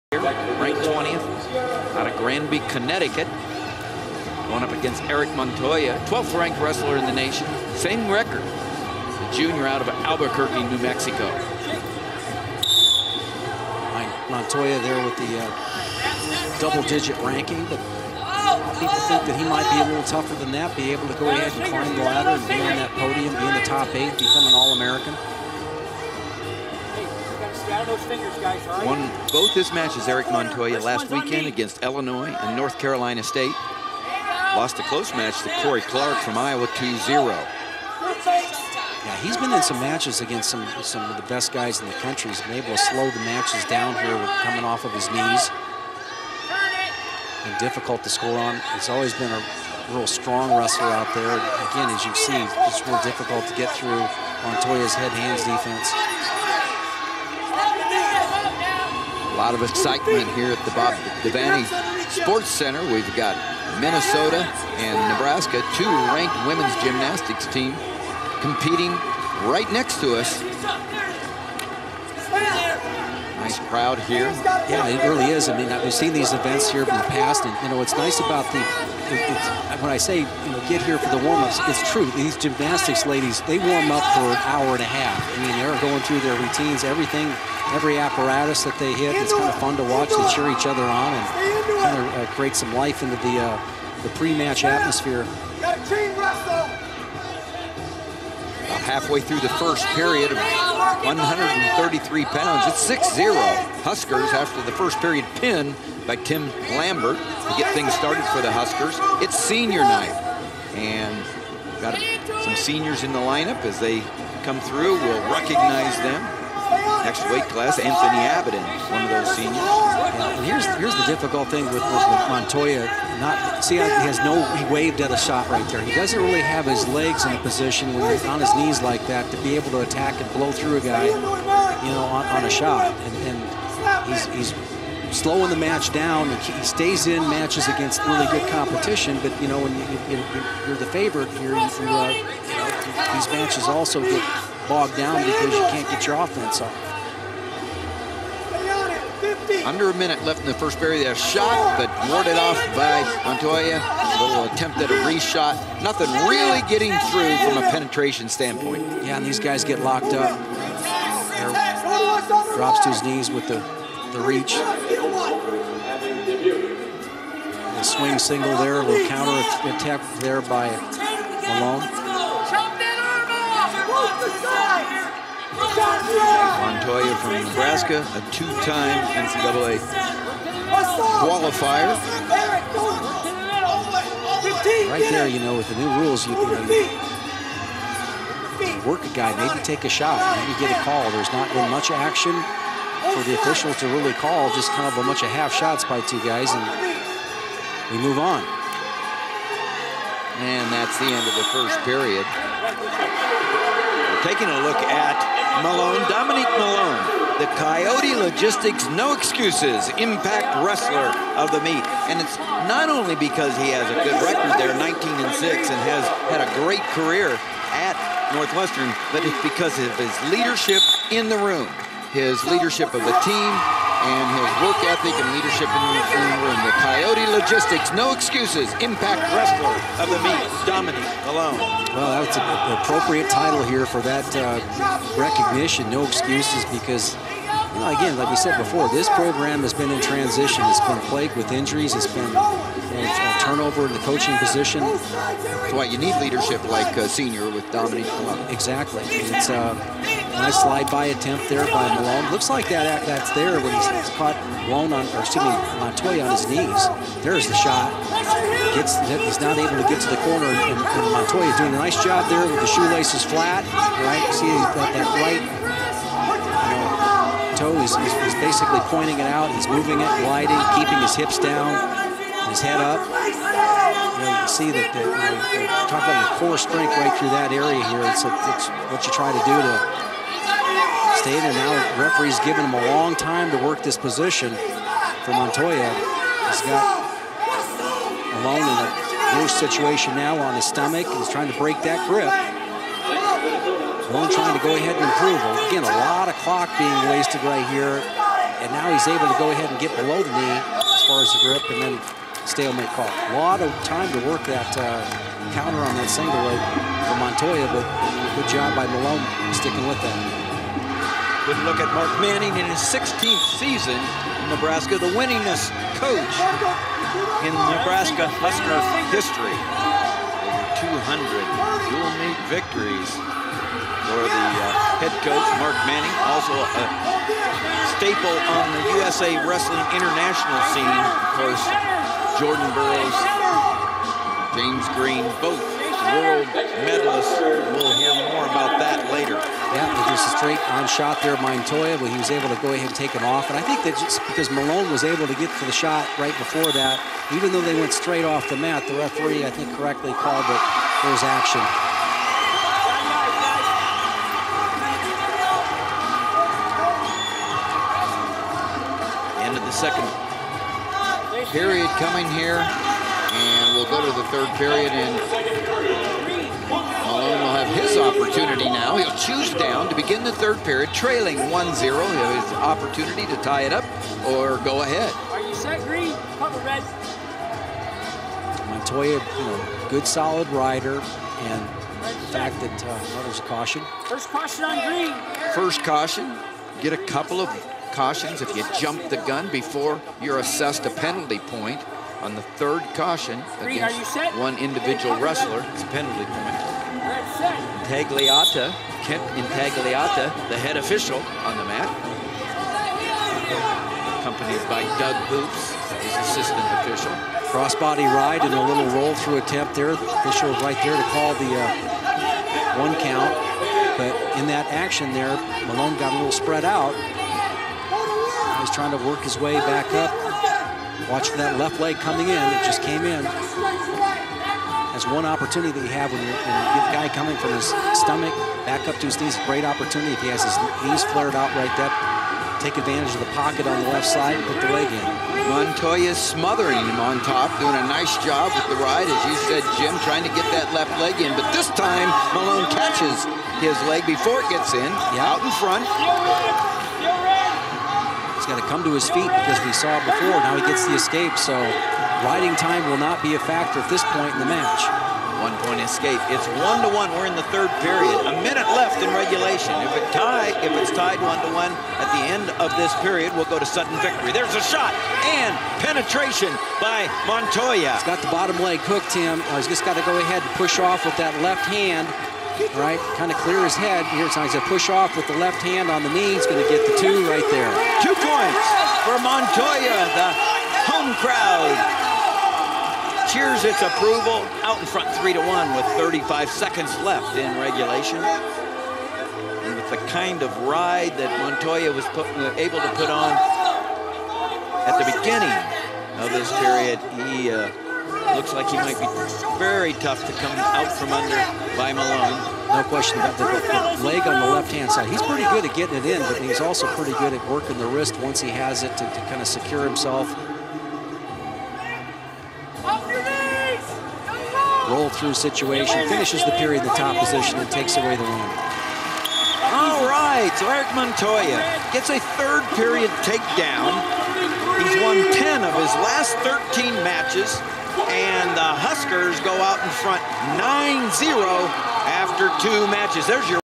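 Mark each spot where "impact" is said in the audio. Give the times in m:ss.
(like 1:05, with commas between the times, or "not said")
3:29, 3:48.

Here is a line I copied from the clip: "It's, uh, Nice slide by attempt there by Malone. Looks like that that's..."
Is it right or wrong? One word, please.
right.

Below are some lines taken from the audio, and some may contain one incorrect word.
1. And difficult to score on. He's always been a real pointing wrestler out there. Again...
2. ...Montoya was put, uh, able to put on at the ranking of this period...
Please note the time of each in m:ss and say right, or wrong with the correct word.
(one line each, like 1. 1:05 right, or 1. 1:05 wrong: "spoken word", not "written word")
1. 0:47 wrong: "strong", not "pointing"
2. 8:11 wrong: "beginning", not "ranking".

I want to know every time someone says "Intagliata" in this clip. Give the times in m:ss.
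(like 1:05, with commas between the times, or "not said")
6:39.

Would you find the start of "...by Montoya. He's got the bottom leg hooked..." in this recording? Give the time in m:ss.
7:46.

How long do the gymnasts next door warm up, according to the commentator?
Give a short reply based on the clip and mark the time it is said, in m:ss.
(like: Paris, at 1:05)
an hour and a half, at 1:24.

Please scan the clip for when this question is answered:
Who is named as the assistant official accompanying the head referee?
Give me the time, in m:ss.
6:44.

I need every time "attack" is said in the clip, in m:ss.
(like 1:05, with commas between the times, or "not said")
2:09, 2:49.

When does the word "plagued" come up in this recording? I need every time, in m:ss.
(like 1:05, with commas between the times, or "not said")
4:01.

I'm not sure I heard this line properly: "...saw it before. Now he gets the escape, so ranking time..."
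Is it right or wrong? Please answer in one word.
wrong.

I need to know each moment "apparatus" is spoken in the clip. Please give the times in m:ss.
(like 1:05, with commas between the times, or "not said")
1:27.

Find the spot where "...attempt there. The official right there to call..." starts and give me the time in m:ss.
6:49.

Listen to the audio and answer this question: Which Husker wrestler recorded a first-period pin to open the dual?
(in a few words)
Tim Lambert.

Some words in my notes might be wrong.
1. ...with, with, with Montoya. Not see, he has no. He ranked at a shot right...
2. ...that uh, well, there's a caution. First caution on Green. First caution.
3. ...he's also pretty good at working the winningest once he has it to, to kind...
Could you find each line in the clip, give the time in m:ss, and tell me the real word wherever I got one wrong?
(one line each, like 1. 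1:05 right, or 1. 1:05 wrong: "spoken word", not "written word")
1. 2:01 wrong: "waved", not "ranked"
2. 6:22 right
3. 8:26 wrong: "wrist", not "winningest".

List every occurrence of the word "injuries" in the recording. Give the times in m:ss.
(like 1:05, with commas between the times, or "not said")
4:01.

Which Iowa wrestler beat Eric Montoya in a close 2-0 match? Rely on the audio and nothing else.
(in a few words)
Cory Clark.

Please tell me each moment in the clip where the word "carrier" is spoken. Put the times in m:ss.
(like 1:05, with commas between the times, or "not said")
not said.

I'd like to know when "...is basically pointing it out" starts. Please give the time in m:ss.
4:28.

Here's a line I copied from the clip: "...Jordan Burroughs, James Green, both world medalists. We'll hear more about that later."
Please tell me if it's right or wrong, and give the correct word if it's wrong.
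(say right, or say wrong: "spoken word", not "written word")
right.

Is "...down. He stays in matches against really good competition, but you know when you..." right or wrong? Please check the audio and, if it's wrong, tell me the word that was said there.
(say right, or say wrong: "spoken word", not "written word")
right.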